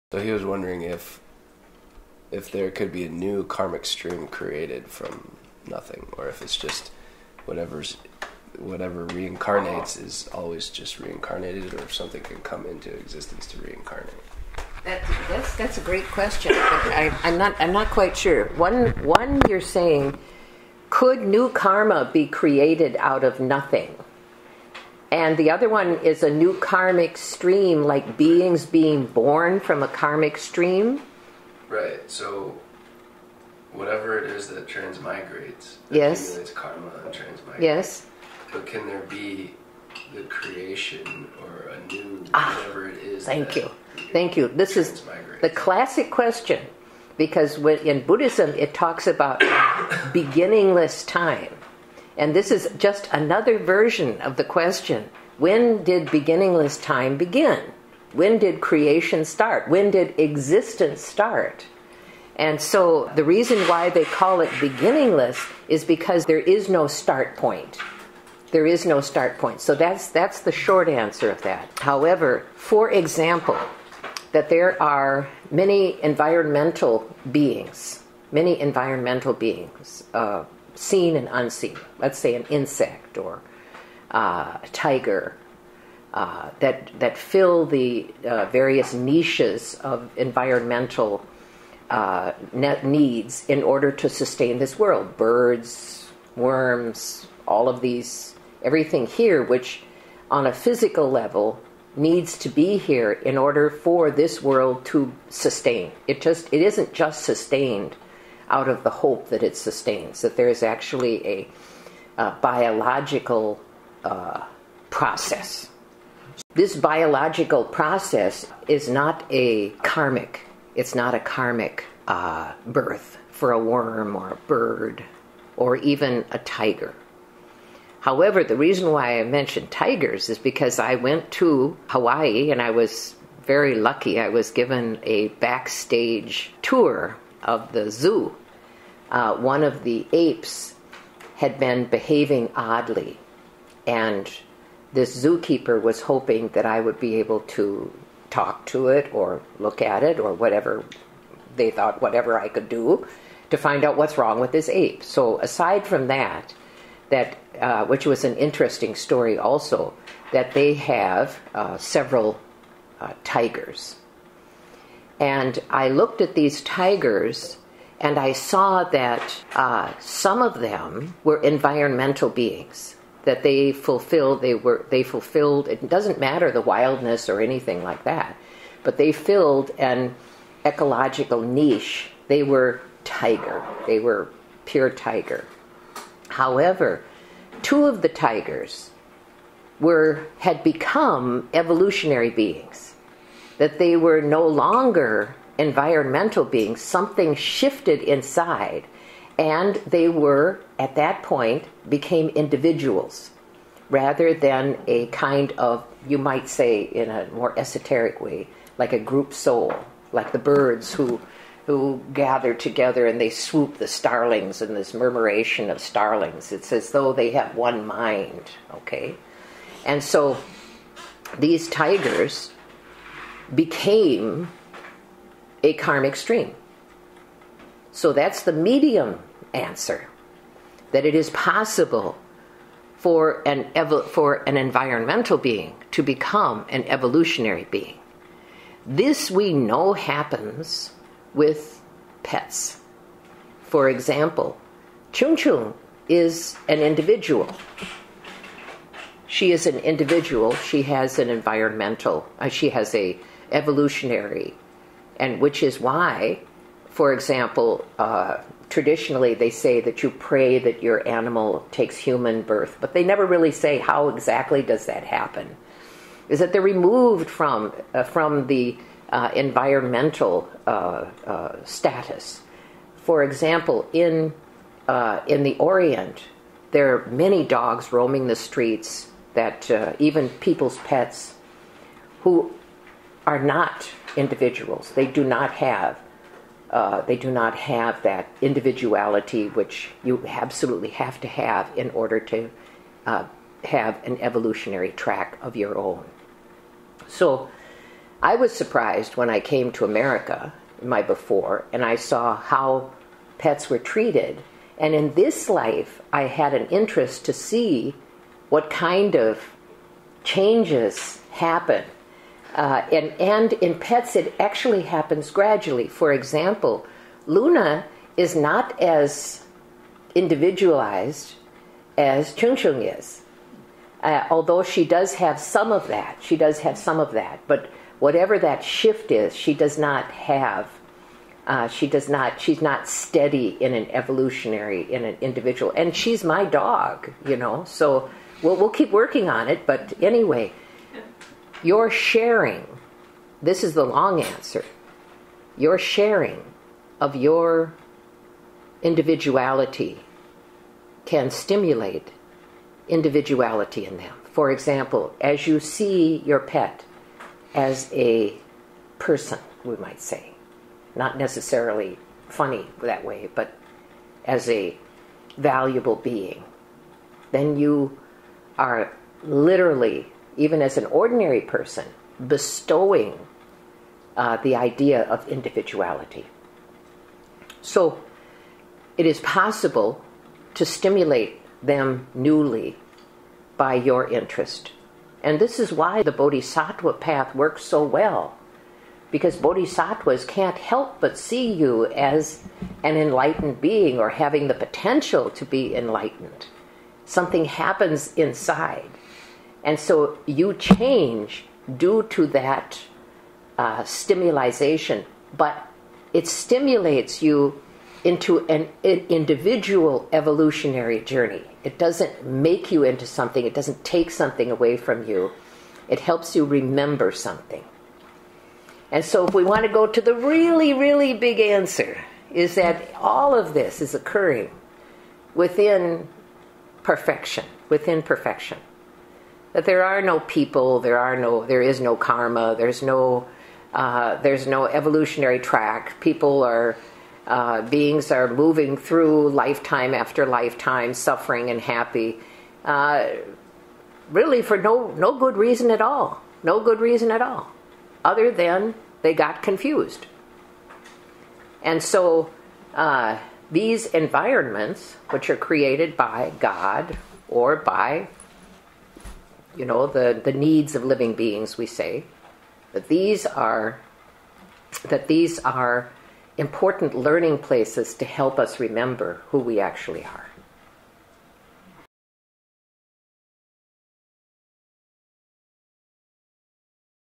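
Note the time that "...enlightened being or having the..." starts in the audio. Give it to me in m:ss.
6:32.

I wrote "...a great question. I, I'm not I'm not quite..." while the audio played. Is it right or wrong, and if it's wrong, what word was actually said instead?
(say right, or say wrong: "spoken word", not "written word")
right.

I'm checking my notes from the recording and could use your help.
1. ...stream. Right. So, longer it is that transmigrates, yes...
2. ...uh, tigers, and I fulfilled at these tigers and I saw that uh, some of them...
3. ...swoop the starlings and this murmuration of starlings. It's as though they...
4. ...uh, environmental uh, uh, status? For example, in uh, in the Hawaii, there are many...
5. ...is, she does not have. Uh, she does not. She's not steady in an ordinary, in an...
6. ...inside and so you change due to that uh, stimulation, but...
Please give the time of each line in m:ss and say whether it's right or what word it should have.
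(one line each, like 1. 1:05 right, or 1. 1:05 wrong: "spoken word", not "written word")
1. 0:30 wrong: "whatever", not "longer"
2. 2:43 wrong: "looked", not "fulfilled"
3. 3:33 right
4. 4:29 wrong: "Orient", not "Hawaii"
5. 5:29 wrong: "evolutionary", not "ordinary"
6. 6:38 right.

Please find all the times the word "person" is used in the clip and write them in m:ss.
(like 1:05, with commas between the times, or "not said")
5:58, 6:11.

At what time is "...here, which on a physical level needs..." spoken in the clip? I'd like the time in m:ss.
1:39.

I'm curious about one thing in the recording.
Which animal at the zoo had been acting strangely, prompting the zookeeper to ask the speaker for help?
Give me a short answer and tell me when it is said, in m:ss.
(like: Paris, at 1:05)
ape, at 2:34.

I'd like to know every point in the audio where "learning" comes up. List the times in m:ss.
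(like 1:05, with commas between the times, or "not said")
7:46.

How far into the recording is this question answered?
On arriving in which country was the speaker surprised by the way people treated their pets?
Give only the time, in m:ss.
4:59.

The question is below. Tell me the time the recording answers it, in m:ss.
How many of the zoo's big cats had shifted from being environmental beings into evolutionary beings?
3:07.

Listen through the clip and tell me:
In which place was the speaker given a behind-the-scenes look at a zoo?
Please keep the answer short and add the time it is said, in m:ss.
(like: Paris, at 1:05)
Hawaii, at 2:11.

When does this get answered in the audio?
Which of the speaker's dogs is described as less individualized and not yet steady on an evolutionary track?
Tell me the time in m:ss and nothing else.
5:17.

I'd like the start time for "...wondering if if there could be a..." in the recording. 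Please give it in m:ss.
0:00.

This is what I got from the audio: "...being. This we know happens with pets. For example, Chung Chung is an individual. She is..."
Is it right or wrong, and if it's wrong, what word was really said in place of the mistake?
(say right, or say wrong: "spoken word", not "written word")
right.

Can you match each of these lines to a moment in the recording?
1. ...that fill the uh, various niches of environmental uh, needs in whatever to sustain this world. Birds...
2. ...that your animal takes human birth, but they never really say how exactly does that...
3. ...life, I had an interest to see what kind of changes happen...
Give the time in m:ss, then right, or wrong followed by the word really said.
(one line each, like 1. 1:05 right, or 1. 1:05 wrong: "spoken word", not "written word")
1. 1:26 wrong: "order", not "whatever"
2. 4:20 right
3. 5:05 right.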